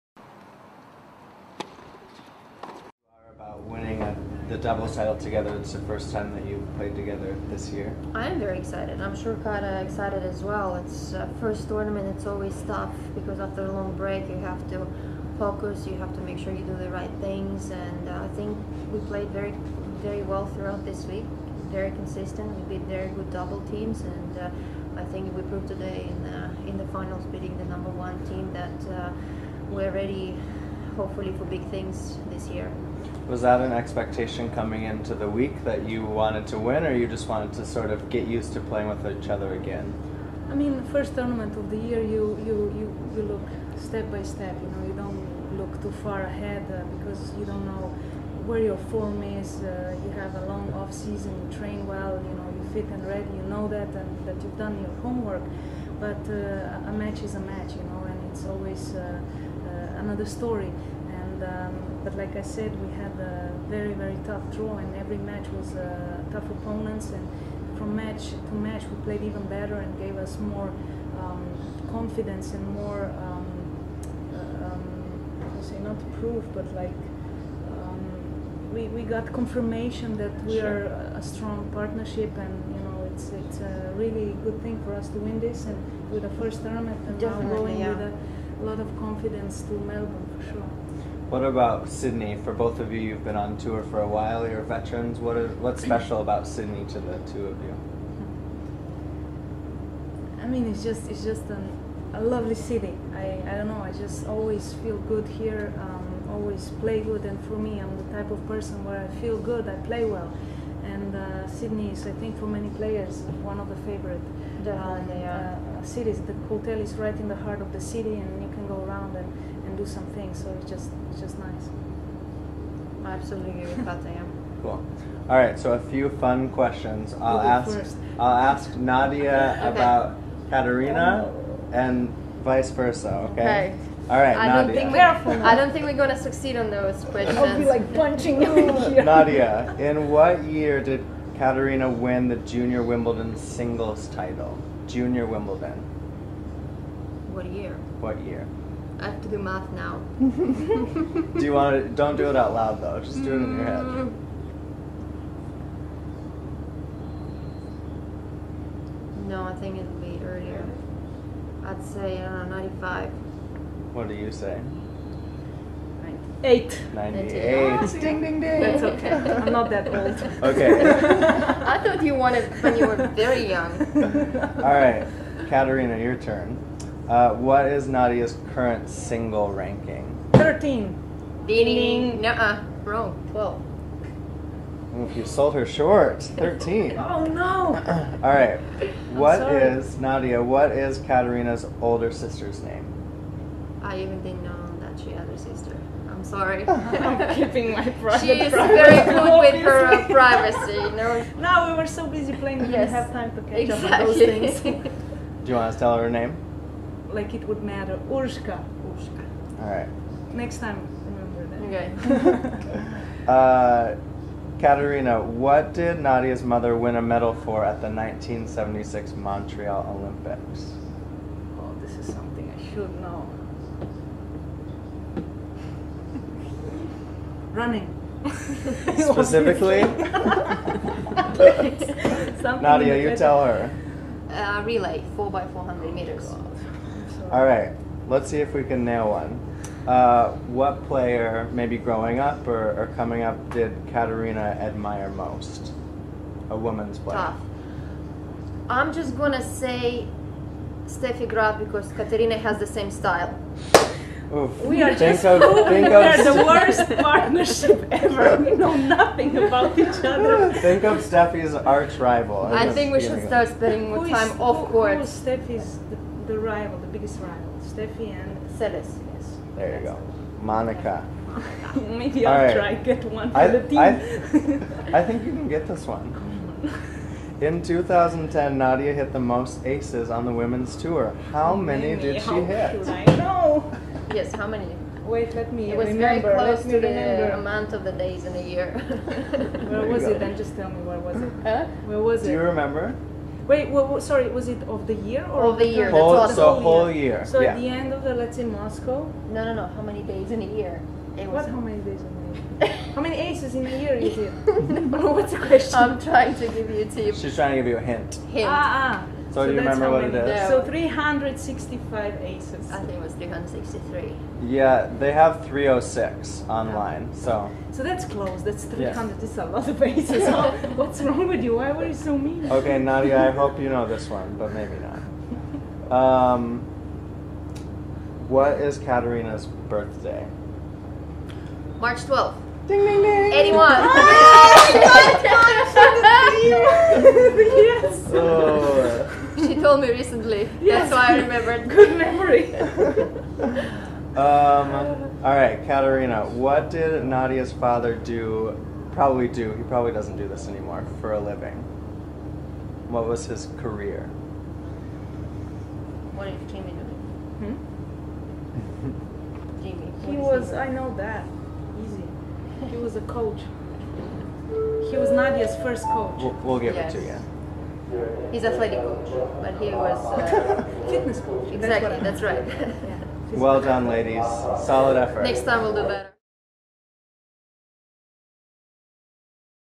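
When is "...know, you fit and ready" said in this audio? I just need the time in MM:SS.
00:52.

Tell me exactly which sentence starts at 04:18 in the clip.
We know nothing about each other.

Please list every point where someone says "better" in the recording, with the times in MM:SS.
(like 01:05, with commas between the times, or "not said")
01:09, 06:15.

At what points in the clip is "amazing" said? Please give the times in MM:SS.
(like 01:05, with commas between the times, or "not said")
not said.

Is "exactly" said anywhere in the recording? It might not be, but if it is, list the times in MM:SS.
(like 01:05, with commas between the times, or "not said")
03:23, 06:11.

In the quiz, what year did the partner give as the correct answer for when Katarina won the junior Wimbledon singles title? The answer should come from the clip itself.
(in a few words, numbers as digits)
1998.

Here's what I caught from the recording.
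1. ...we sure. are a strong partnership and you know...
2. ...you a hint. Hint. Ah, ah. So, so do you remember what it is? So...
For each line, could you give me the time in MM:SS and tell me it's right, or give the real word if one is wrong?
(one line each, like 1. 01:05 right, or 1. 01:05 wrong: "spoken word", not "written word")
1. 01:20 right
2. 05:07 right.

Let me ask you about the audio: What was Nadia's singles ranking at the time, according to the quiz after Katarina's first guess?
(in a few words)
12.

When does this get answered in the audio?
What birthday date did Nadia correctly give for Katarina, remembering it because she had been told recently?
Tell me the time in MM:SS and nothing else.
05:31.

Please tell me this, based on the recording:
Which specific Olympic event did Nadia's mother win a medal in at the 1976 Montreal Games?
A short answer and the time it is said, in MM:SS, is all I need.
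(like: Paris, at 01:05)
4x400 meters relay, at 03:54.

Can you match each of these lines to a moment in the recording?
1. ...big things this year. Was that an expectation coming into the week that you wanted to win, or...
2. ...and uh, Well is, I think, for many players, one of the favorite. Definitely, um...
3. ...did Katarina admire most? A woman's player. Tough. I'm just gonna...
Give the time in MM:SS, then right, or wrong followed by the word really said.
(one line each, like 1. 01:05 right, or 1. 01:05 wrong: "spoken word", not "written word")
1. 00:31 right
2. 01:50 wrong: "Sydney", not "Well"
3. 04:03 right.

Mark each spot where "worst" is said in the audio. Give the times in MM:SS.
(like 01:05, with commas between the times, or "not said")
04:16.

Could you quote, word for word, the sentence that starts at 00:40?
I mean, first tournament of the year, you you you, you look step by step.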